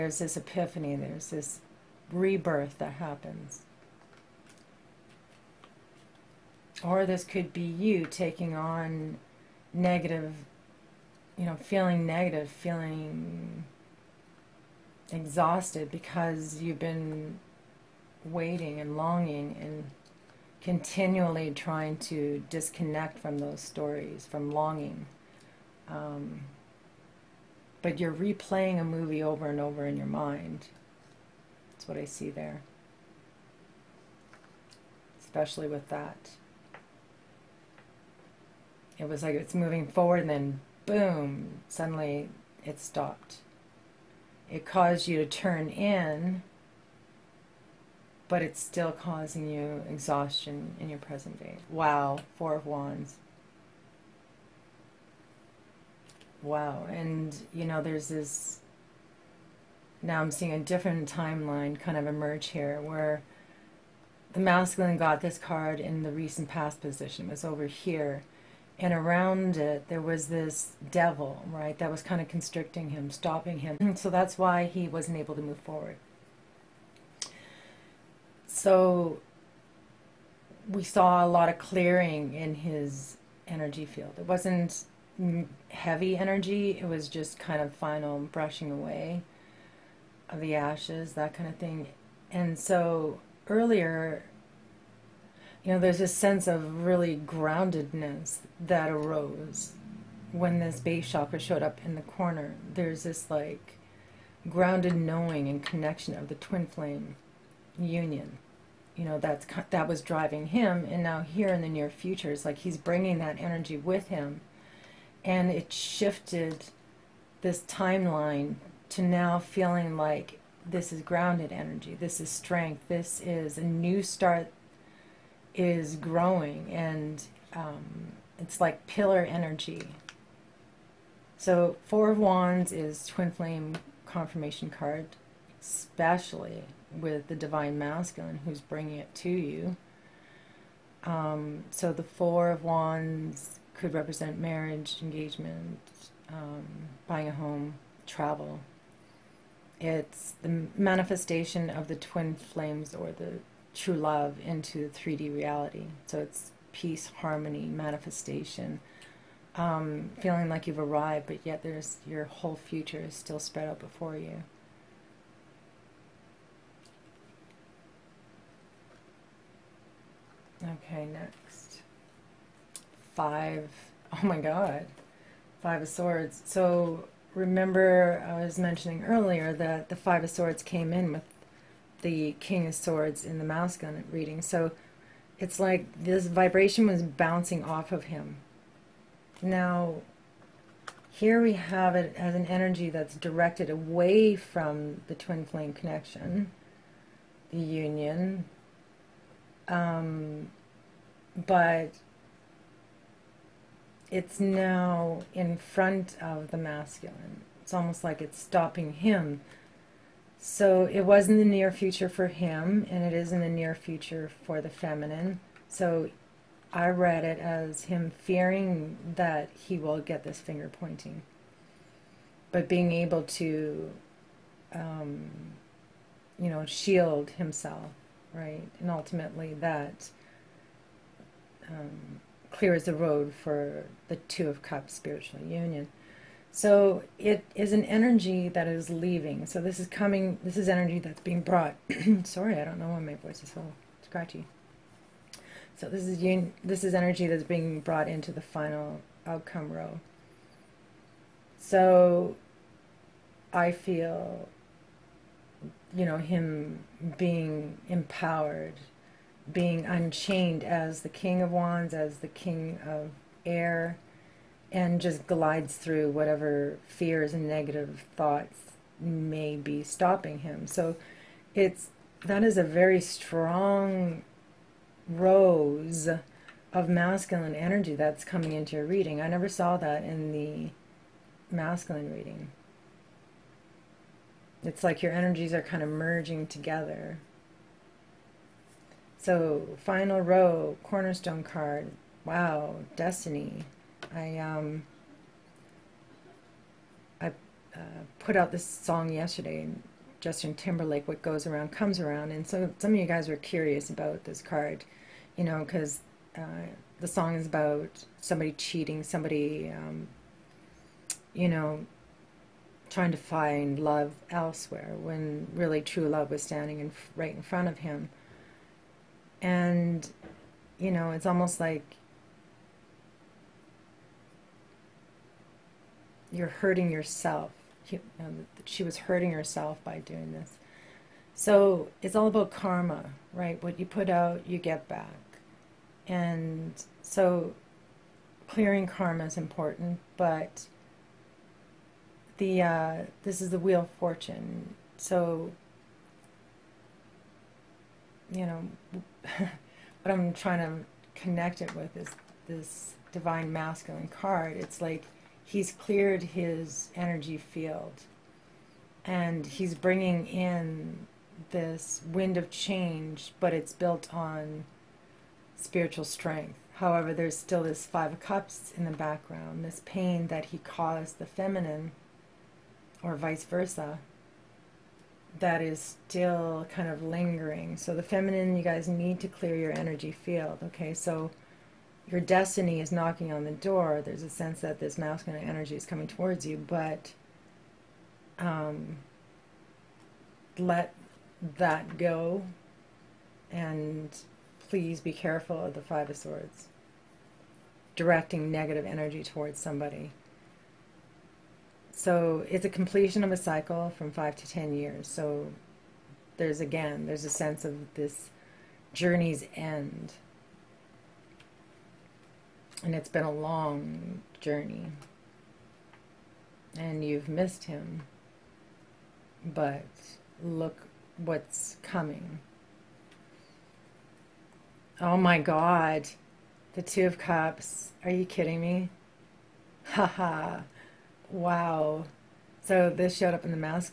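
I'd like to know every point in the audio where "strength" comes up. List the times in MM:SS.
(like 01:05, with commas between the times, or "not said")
02:02, 06:06.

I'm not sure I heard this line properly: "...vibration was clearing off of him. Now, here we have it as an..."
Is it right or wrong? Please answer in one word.
wrong.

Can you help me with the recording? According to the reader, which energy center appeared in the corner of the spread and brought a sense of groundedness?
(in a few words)
base chakra.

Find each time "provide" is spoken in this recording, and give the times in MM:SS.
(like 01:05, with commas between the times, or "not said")
not said.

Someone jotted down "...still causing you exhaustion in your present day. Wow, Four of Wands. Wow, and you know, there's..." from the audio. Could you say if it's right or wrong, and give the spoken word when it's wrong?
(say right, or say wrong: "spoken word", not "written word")
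right.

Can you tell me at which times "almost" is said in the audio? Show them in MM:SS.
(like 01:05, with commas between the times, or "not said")
03:27, 05:21.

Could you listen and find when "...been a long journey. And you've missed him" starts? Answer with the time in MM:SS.
06:53.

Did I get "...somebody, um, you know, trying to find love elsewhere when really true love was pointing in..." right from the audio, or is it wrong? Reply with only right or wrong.
wrong.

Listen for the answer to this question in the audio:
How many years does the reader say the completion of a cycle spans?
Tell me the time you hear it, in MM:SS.
06:44.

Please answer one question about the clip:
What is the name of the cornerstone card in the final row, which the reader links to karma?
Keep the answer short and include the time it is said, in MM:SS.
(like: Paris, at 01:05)
wheel of fortune, at 05:43.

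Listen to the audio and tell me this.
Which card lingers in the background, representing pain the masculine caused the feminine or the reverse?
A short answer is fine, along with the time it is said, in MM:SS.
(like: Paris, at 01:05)
Five of Cups, at 06:07.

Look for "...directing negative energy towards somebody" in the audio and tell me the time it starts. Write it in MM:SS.
06:37.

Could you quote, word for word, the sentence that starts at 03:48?
And ultimately that um, clears the road for the Two of Cups spiritual union.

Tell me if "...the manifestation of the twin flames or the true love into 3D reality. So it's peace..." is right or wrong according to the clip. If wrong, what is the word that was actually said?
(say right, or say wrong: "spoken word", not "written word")
right.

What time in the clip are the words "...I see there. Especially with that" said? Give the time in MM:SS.
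00:31.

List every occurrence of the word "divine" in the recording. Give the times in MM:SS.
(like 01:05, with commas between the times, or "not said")
02:17, 05:53.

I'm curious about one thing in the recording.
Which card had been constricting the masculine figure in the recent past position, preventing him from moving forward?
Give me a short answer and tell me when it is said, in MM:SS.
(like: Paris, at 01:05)
devil, at 01:10.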